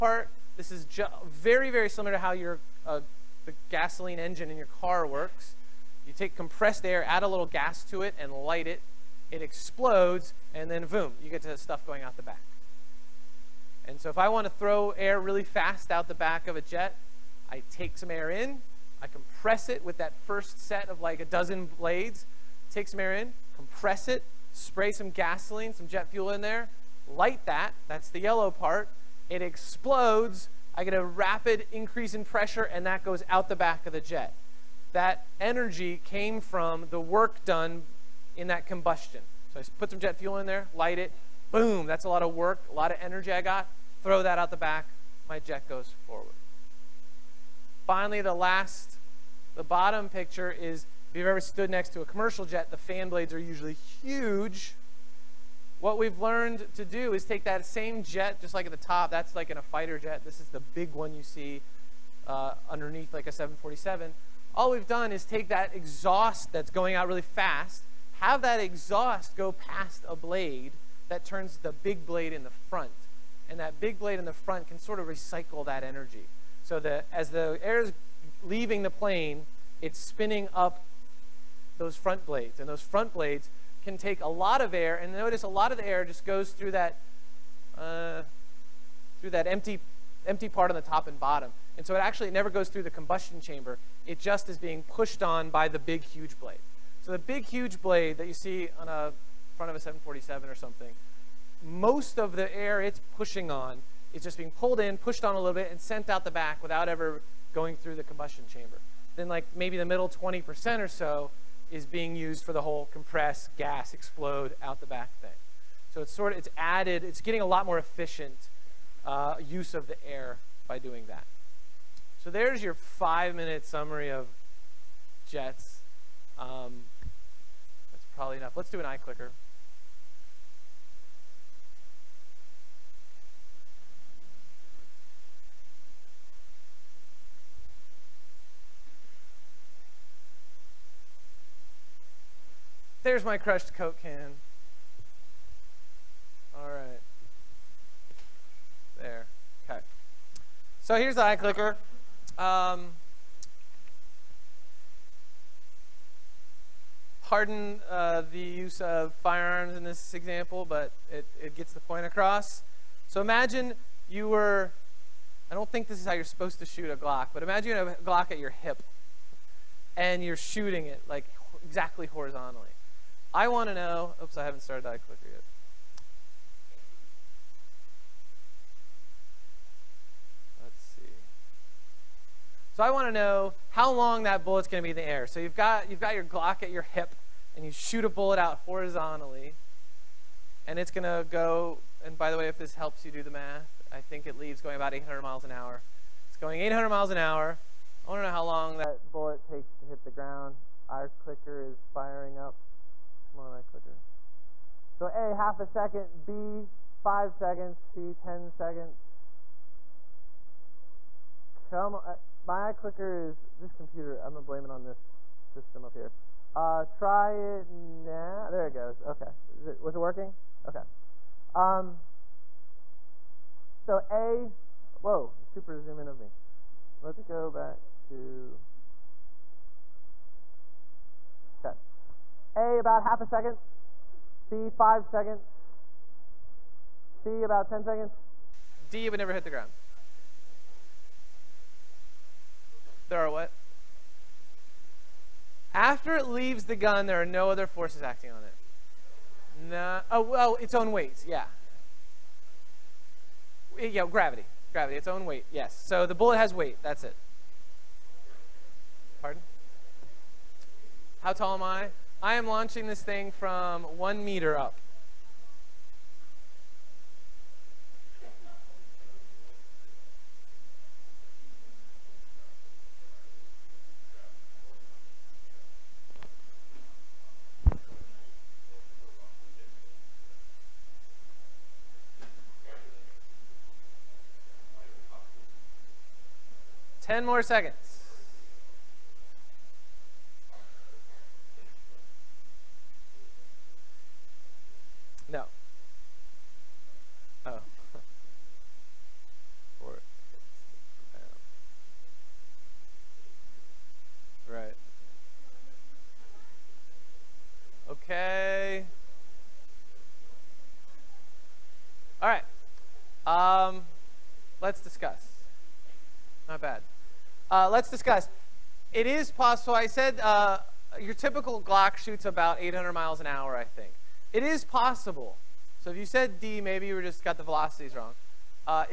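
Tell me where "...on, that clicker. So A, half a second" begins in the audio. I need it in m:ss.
3:23.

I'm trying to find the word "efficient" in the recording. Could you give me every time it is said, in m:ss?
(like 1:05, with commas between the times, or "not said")
1:57.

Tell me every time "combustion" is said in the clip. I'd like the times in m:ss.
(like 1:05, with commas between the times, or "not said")
0:38, 1:32, 1:48.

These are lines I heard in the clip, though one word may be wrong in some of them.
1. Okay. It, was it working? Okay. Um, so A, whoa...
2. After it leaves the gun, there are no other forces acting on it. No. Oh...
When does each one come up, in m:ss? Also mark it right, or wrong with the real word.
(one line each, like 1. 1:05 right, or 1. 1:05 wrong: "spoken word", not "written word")
1. 3:39 right
2. 4:05 right.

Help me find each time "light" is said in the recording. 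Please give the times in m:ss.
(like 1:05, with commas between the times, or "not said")
0:08, 0:27, 0:40.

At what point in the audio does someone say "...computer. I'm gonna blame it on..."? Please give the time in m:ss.
3:33.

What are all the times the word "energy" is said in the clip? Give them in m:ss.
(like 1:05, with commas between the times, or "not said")
0:35, 0:42, 1:15.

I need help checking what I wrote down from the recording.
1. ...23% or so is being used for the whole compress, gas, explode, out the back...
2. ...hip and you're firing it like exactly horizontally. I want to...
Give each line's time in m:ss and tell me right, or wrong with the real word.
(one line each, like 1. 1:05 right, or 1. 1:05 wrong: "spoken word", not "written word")
1. 1:50 wrong: "20", not "23"
2. 2:48 wrong: "shooting", not "firing".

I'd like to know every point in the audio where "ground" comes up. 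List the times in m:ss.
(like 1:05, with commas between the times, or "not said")
3:20, 3:59.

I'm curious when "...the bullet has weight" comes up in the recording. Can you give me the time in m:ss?
4:16.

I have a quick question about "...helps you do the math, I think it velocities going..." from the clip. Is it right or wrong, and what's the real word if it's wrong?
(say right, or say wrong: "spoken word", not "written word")
wrong: "leaves", not "velocities".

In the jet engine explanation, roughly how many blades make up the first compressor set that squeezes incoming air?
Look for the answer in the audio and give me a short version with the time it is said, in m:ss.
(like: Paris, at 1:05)
a dozen, at 0:21.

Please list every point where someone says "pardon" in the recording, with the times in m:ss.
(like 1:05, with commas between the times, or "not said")
2:37, 4:19.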